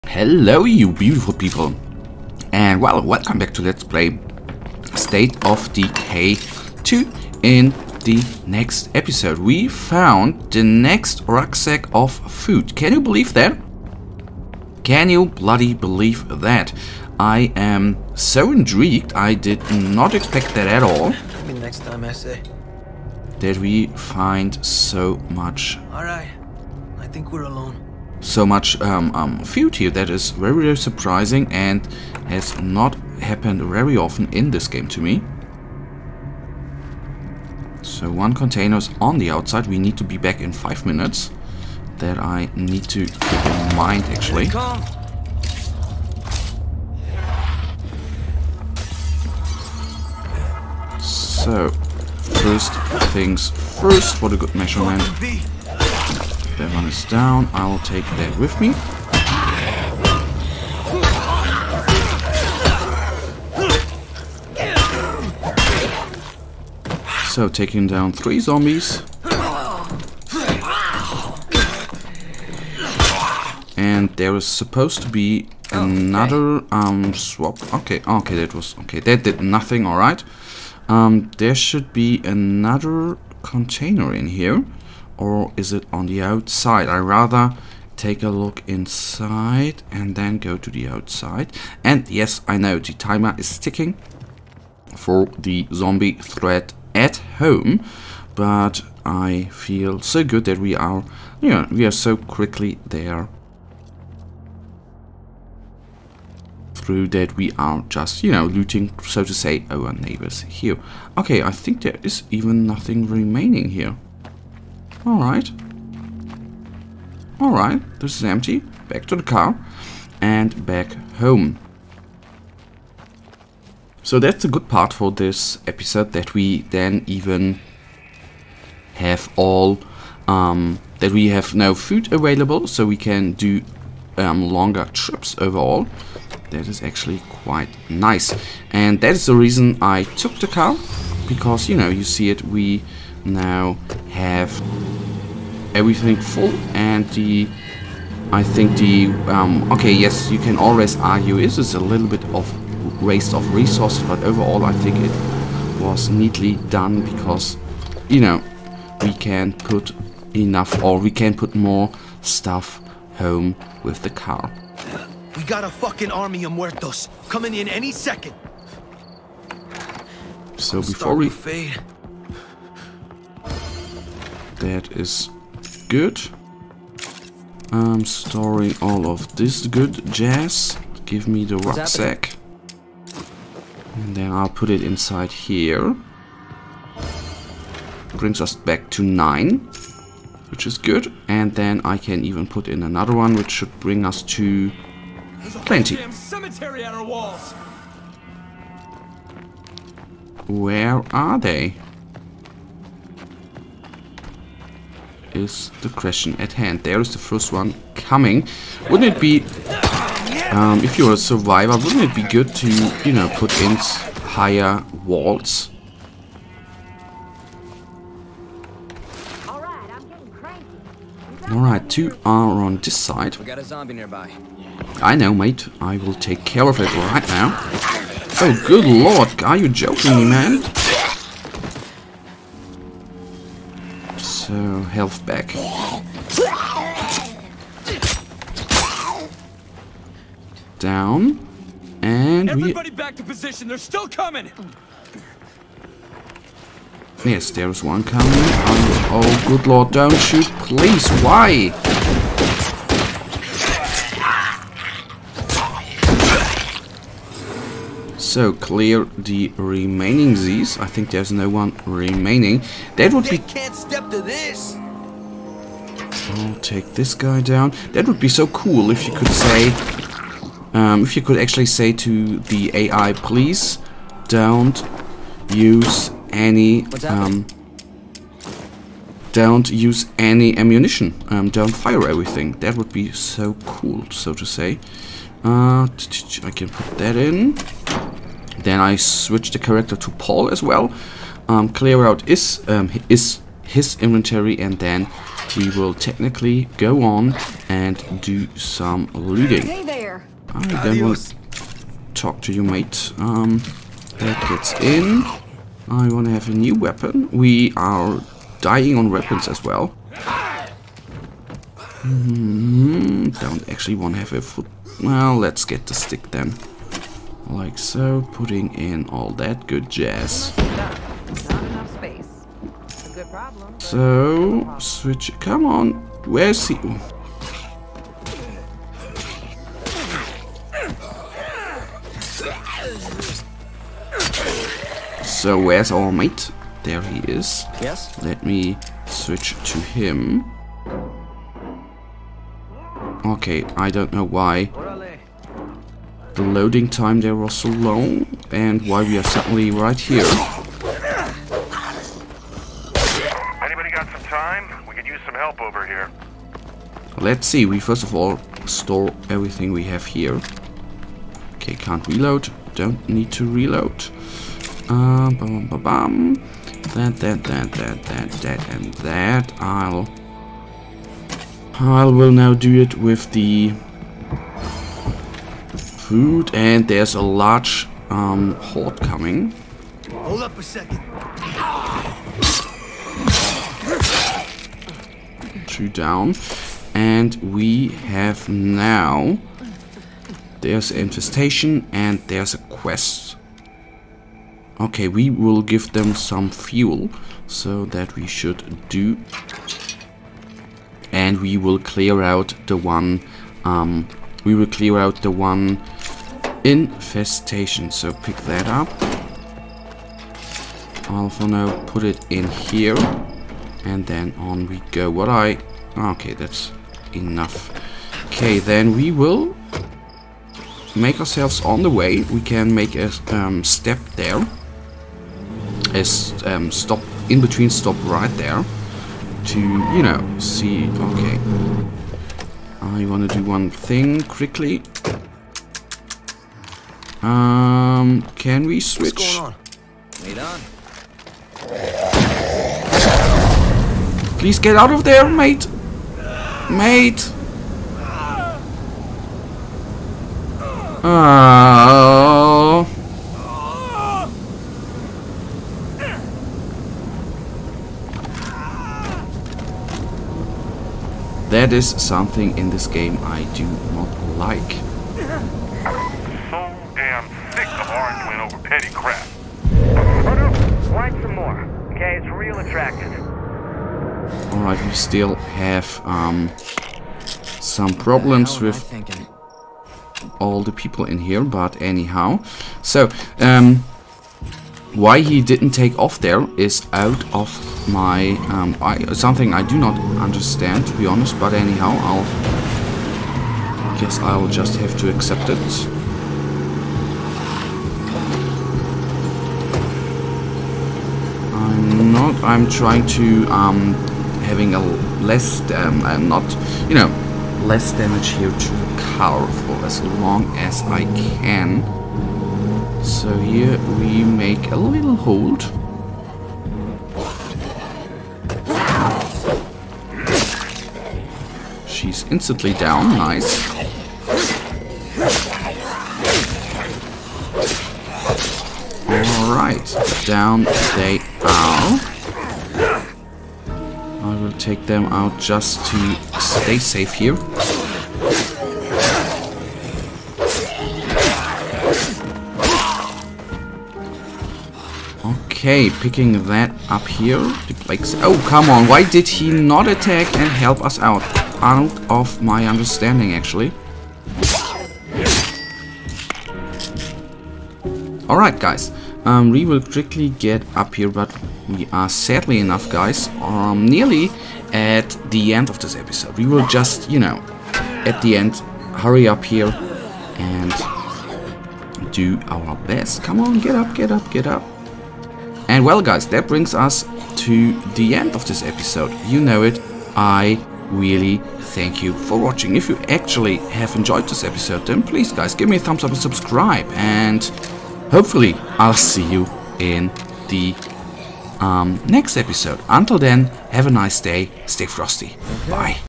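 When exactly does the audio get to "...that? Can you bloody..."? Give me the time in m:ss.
0:13.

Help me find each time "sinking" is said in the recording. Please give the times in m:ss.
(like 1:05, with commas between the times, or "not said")
not said.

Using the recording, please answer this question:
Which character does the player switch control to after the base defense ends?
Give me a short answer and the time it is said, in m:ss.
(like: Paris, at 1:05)
Paul, at 4:50.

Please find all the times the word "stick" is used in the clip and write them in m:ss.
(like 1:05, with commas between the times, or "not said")
5:15.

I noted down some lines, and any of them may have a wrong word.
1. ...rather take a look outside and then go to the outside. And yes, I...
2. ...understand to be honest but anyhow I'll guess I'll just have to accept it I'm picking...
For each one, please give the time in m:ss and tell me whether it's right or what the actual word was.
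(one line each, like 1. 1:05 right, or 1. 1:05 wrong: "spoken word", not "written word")
1. 1:26 wrong: "inside", not "outside"
2. 8:10 wrong: "trying", not "picking".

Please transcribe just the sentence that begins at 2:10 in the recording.
Um, that we have now food available, so we can do um, longer trips overall.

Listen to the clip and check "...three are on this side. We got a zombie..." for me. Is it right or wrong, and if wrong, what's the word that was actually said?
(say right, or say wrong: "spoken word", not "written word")
wrong: "two", not "three".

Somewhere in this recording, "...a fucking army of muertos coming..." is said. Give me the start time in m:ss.
2:45.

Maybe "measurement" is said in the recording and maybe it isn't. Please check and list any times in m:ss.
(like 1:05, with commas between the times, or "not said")
0:54.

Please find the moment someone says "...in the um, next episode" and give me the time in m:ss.
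9:49.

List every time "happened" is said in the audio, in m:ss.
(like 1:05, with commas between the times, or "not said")
0:33.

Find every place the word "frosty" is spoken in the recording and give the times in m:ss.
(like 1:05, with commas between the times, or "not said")
9:54.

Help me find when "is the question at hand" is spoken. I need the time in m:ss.
3:25.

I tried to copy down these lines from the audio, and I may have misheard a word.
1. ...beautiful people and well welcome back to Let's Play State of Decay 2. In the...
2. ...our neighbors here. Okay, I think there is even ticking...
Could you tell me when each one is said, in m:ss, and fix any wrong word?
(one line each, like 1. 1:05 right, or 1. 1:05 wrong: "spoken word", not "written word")
1. 0:00 right
2. 1:49 wrong: "nothing", not "ticking".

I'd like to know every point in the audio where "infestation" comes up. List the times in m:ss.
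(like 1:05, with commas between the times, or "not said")
6:30, 6:46.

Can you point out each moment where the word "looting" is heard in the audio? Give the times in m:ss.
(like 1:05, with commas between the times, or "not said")
1:48, 4:59.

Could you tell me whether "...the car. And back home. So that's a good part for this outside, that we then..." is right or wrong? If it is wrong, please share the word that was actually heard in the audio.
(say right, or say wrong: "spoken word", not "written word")
wrong: "episode", not "outside".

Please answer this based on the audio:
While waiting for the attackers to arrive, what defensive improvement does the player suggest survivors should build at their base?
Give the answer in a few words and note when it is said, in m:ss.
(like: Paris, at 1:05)
Higher walls, at 3:34.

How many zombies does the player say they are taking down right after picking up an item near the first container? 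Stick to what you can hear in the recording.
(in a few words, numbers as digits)
3.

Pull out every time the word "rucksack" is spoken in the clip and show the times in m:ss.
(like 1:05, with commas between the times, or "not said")
0:11, 3:01.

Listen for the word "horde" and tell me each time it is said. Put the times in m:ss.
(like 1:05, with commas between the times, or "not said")
6:18.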